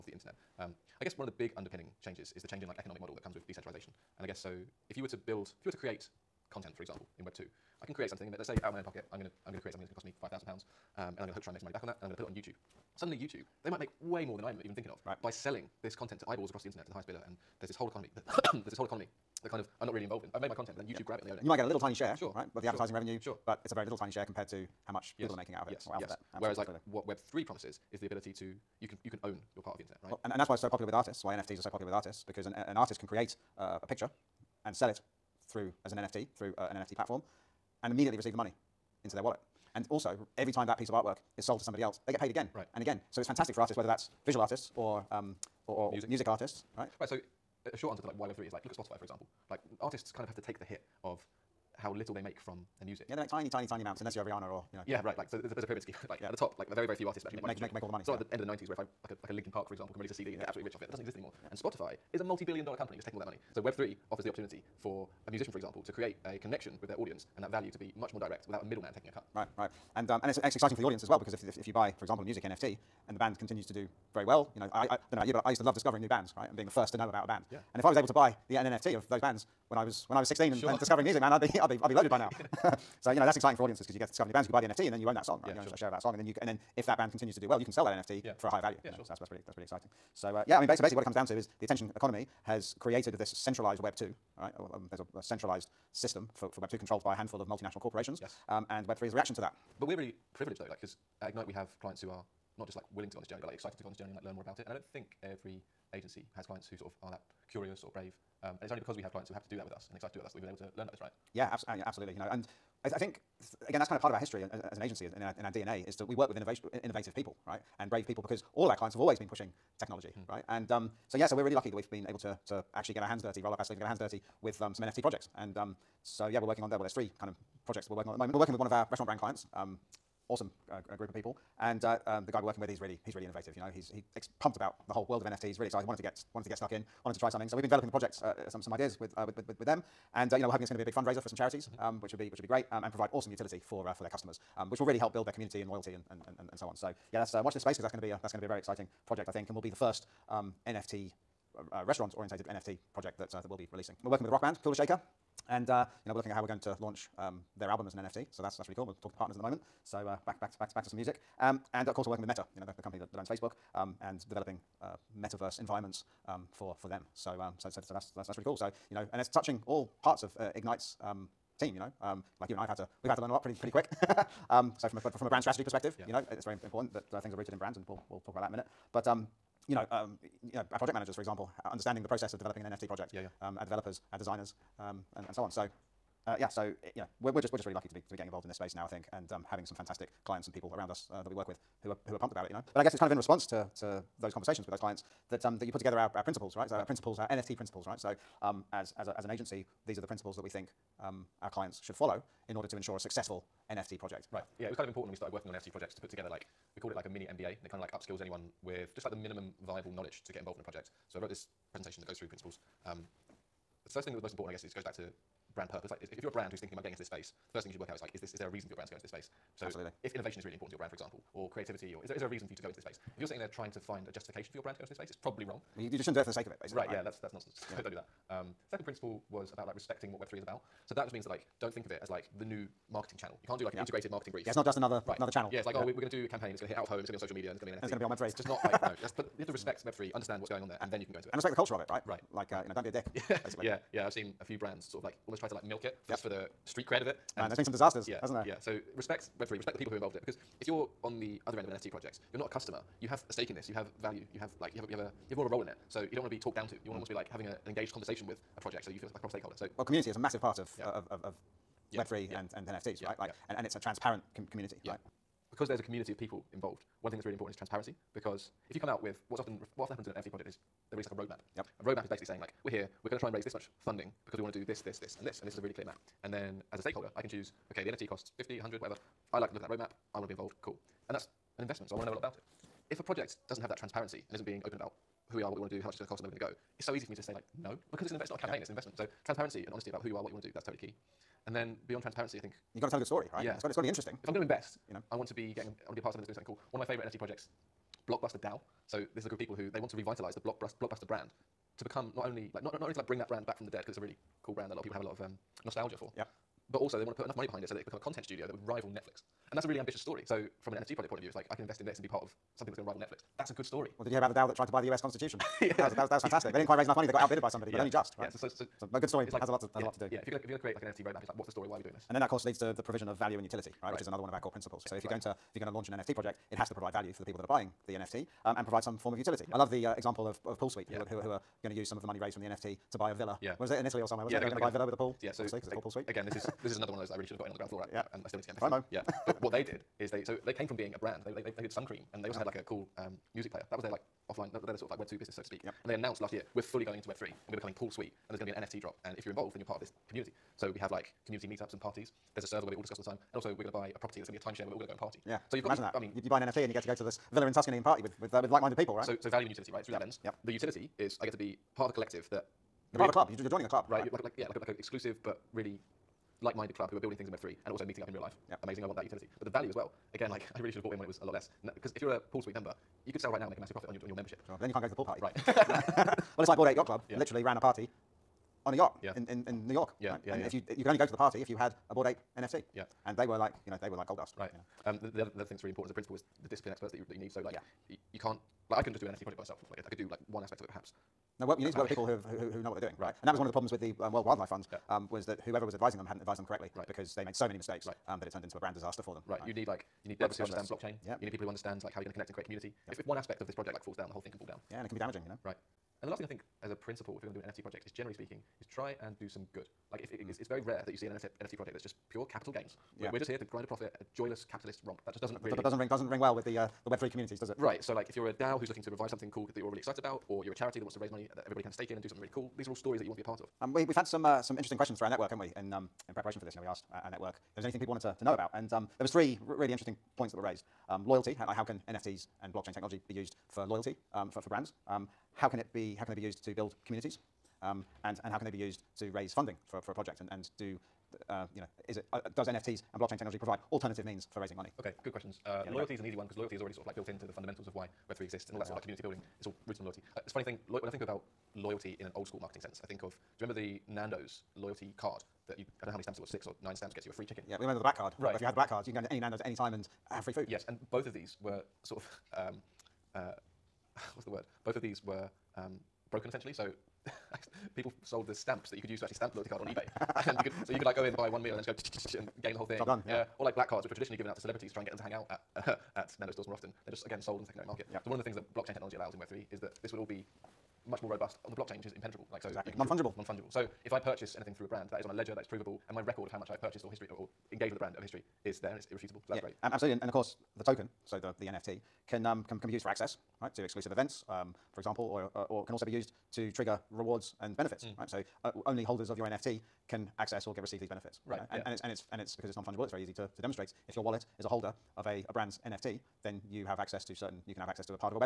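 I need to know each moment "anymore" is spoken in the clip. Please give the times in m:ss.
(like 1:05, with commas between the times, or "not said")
1:01.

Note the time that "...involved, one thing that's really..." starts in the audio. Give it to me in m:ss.
4:26.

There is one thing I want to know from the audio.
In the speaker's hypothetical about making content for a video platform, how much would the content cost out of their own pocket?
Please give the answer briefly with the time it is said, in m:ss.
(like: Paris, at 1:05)
£5,000, at 0:10.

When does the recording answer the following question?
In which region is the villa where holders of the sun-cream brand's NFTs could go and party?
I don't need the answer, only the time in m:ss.
5:57.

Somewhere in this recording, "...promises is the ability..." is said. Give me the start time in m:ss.
0:27.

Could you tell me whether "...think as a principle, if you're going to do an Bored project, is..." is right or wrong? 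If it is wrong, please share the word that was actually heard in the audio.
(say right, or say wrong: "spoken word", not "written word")
wrong: "NFT", not "Bored".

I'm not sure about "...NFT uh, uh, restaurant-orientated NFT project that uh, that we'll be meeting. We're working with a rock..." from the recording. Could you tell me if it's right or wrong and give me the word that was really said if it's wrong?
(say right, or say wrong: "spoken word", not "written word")
wrong: "releasing", not "meeting".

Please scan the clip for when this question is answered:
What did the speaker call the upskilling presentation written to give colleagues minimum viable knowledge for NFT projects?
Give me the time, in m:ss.
3:27.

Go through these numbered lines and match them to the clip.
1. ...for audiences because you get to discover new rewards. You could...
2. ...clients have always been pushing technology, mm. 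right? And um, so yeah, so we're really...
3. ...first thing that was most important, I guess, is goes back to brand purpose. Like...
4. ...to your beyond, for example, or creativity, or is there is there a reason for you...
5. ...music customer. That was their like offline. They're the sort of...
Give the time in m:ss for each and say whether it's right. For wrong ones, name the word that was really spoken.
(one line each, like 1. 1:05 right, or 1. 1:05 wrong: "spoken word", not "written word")
1. 1:23 wrong: "bands", not "rewards"
2. 1:58 right
3. 3:33 right
4. 3:40 wrong: "brand", not "beyond"
5. 5:43 wrong: "player", not "customer".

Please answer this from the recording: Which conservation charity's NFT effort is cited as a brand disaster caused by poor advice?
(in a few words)
World Wildlife Fund.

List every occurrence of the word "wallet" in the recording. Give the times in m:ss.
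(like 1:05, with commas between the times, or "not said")
0:39, 8:24.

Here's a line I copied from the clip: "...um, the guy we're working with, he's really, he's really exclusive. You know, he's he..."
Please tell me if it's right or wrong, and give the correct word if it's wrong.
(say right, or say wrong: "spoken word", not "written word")
wrong: "innovative", not "exclusive".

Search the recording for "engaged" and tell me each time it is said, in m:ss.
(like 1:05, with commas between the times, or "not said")
4:17, 8:07.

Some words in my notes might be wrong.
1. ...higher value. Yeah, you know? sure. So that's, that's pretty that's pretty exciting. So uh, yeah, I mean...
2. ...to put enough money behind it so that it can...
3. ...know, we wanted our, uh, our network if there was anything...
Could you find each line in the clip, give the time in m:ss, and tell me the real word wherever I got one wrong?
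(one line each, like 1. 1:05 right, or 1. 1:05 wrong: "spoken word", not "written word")
1. 1:28 right
2. 5:07 right
3. 7:06 wrong: "asked", not "wanted".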